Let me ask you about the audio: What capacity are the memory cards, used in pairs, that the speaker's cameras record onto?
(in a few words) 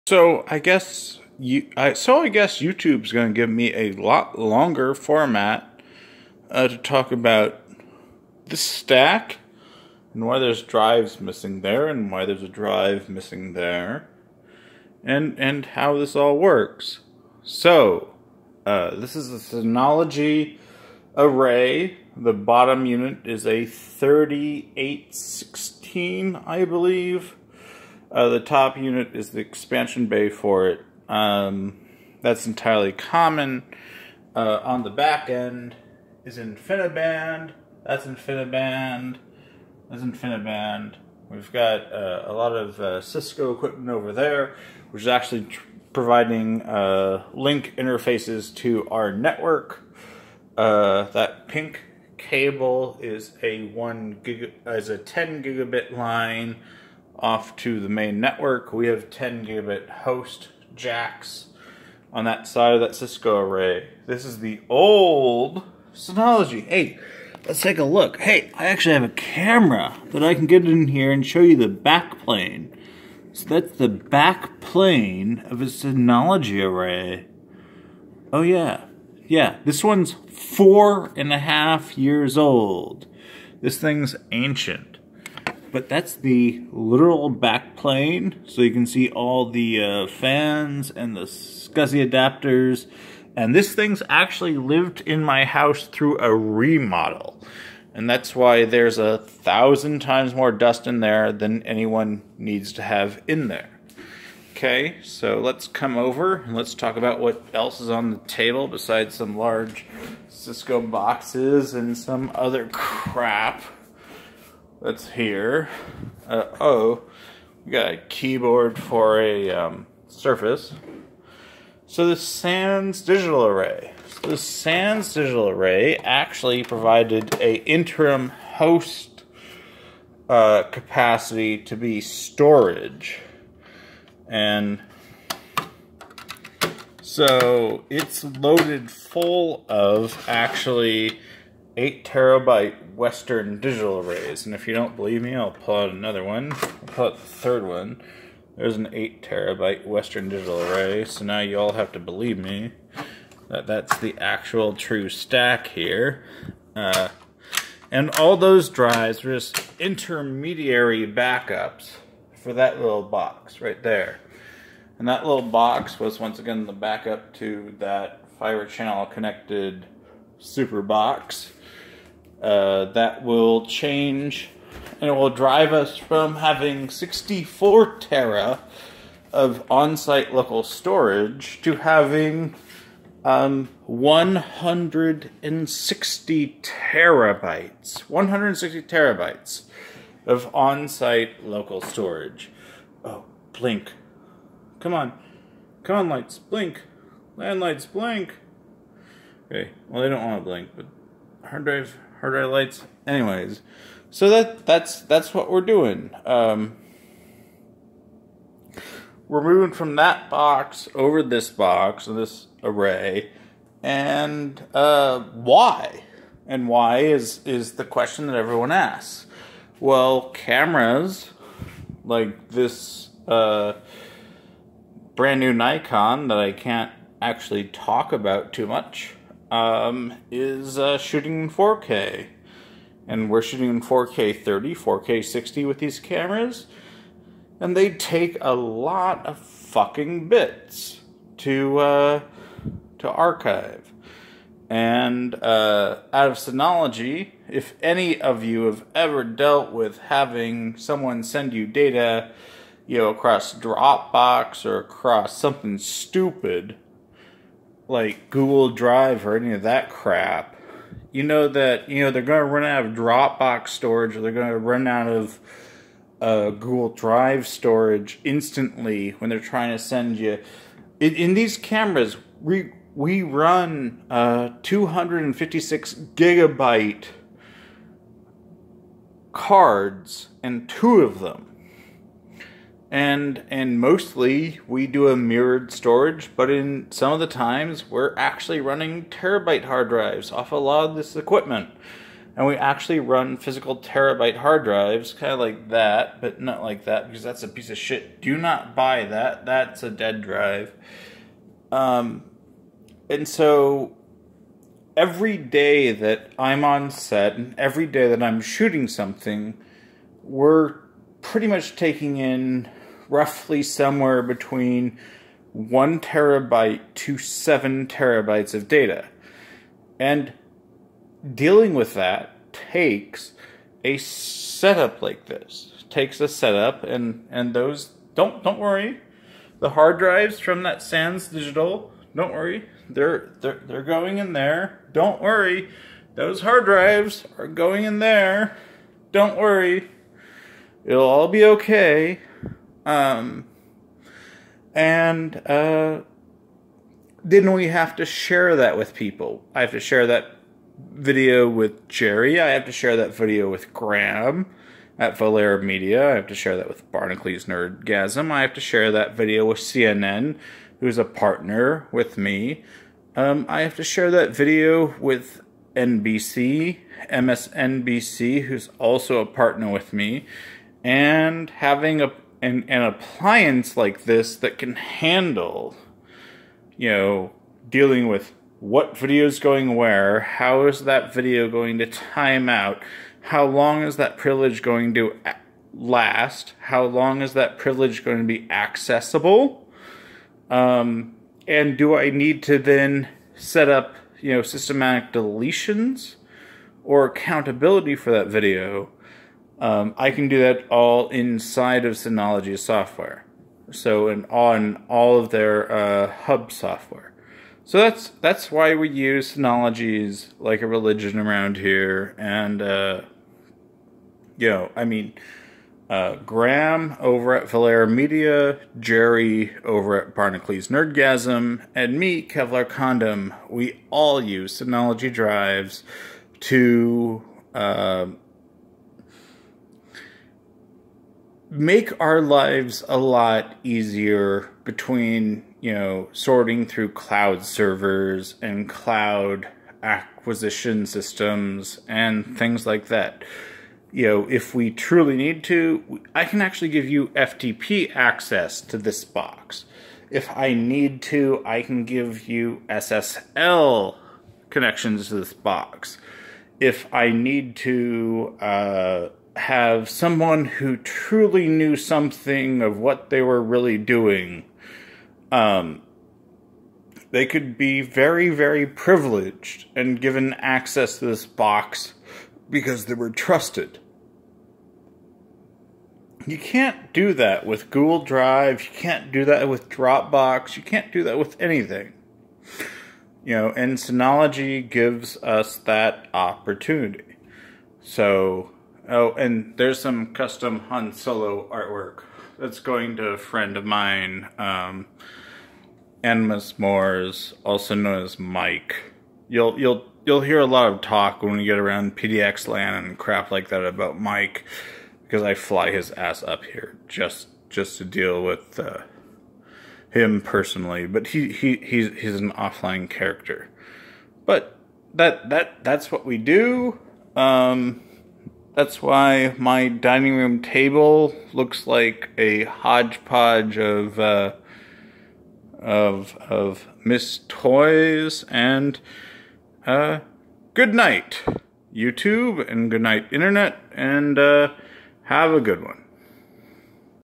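256 gigabytes.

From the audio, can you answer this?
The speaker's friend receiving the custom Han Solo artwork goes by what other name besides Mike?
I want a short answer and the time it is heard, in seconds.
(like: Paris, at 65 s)
Animus Moores, at 496 s.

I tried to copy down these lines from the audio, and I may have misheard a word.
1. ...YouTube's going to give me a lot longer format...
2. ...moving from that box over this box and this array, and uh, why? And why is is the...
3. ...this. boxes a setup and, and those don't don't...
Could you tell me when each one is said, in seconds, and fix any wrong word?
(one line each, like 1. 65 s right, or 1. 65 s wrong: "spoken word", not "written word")
1. 2 s right
2. 209 s right
3. 325 s wrong: "takes", not "boxes".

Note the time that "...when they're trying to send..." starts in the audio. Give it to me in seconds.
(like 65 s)
269 s.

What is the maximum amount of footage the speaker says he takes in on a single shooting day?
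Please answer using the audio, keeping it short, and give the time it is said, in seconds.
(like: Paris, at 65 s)
7 terabytes, at 317 s.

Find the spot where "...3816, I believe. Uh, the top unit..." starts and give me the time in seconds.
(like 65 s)
23 s.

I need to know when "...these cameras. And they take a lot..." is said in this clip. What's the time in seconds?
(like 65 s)
235 s.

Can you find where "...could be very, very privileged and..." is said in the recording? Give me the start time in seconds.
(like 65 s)
467 s.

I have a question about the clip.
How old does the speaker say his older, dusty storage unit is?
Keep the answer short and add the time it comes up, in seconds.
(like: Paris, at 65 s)
4.5 years, at 80 s.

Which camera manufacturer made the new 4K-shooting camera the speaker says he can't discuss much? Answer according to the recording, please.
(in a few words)
Nikon.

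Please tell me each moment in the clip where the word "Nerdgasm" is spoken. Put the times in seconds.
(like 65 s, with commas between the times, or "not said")
357 s, 420 s.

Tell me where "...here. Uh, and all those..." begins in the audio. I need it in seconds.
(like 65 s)
155 s.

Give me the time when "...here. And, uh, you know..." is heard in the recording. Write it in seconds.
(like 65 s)
411 s.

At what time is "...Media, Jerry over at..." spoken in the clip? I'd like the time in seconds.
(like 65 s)
417 s.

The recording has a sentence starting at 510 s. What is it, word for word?
But he he he's he's an offline character, but that that that's what we do.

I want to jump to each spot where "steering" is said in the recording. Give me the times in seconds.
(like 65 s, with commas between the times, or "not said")
not said.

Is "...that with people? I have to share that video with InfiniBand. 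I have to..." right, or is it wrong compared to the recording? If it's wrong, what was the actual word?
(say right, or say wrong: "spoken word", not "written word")
wrong: "Jerry", not "InfiniBand".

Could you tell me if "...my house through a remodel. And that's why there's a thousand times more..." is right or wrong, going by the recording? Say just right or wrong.
right.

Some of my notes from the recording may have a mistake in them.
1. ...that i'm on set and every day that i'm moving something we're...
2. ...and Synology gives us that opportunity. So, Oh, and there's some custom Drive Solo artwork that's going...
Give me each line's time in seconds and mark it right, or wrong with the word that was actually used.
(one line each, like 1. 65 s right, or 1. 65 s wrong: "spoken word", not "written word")
1. 305 s wrong: "shooting", not "moving"
2. 483 s wrong: "Han", not "Drive".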